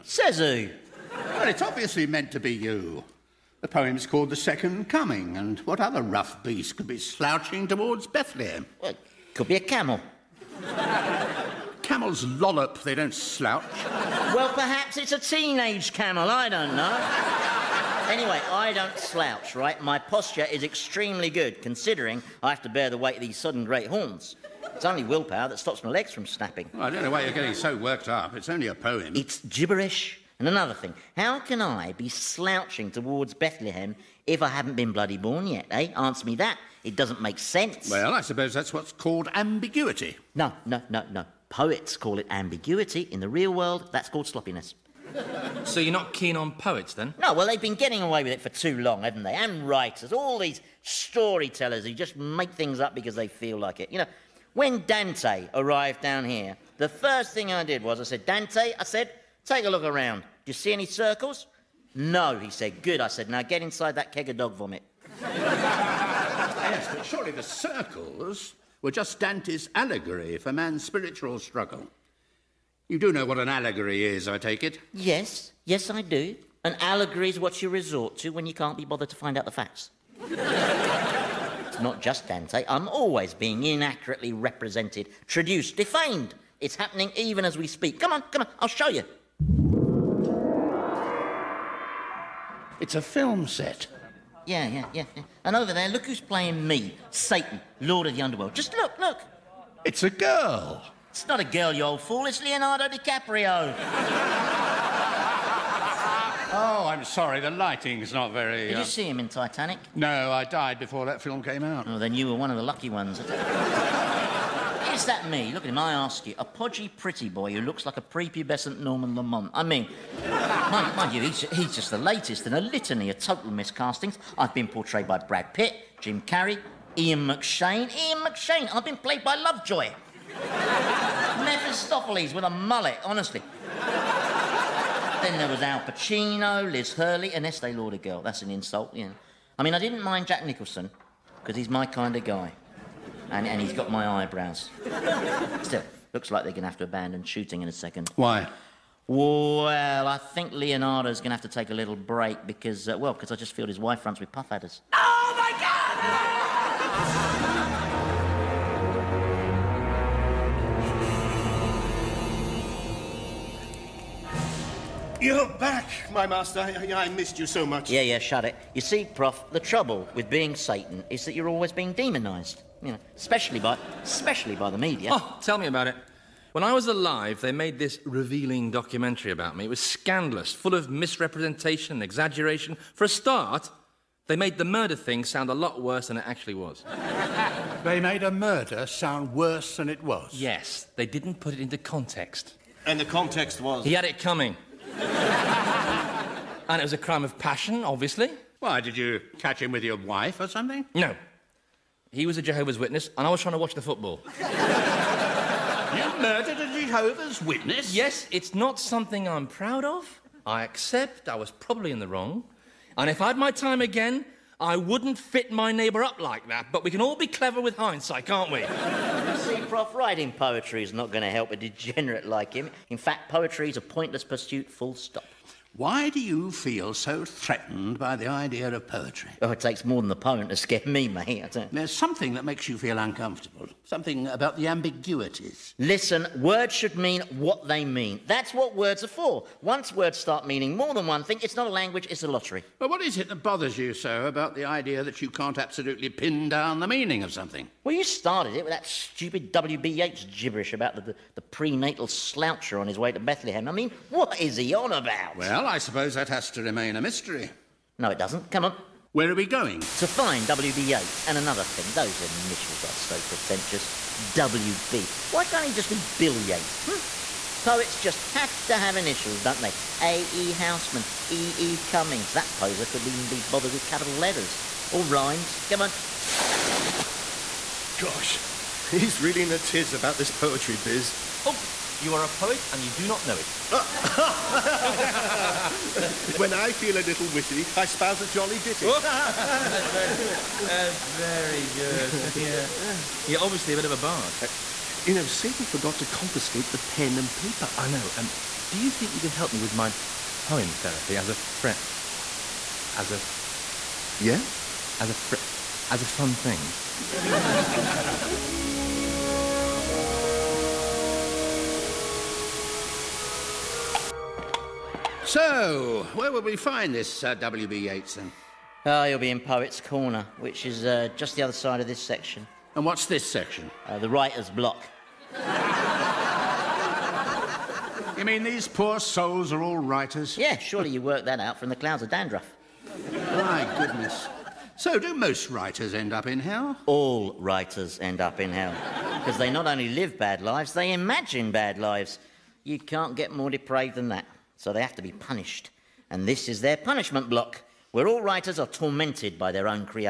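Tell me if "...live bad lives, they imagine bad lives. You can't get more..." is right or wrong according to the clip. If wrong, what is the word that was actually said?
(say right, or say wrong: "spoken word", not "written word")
right.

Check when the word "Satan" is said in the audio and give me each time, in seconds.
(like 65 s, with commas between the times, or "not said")
97 s, 170 s, 295 s.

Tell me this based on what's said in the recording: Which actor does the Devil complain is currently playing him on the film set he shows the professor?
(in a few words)
Leonardo DiCaprio.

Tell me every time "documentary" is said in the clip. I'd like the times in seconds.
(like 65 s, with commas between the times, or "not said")
178 s.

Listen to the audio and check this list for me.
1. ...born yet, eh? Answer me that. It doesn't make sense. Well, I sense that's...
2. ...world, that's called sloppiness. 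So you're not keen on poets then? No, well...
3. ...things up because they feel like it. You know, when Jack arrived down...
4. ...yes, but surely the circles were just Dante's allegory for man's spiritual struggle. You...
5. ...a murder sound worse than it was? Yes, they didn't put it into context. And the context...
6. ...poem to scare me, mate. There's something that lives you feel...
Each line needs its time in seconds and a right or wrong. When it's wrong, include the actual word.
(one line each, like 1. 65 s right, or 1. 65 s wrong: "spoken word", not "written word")
1. 35 s wrong: "suppose", not "sense"
2. 43 s right
3. 52 s wrong: "Dante", not "Jack"
4. 65 s right
5. 188 s right
6. 230 s wrong: "makes", not "lives".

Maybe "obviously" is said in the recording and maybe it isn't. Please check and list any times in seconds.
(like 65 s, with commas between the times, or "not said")
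1 s, 197 s, 293 s.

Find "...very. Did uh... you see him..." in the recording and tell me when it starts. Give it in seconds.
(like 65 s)
108 s.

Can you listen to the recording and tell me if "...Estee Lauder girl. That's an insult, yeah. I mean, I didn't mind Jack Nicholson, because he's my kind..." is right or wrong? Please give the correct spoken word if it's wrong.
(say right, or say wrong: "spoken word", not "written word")
right.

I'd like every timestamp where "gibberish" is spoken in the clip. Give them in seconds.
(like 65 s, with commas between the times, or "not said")
29 s, 250 s.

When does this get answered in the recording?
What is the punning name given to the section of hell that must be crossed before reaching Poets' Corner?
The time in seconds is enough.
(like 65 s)
323 s.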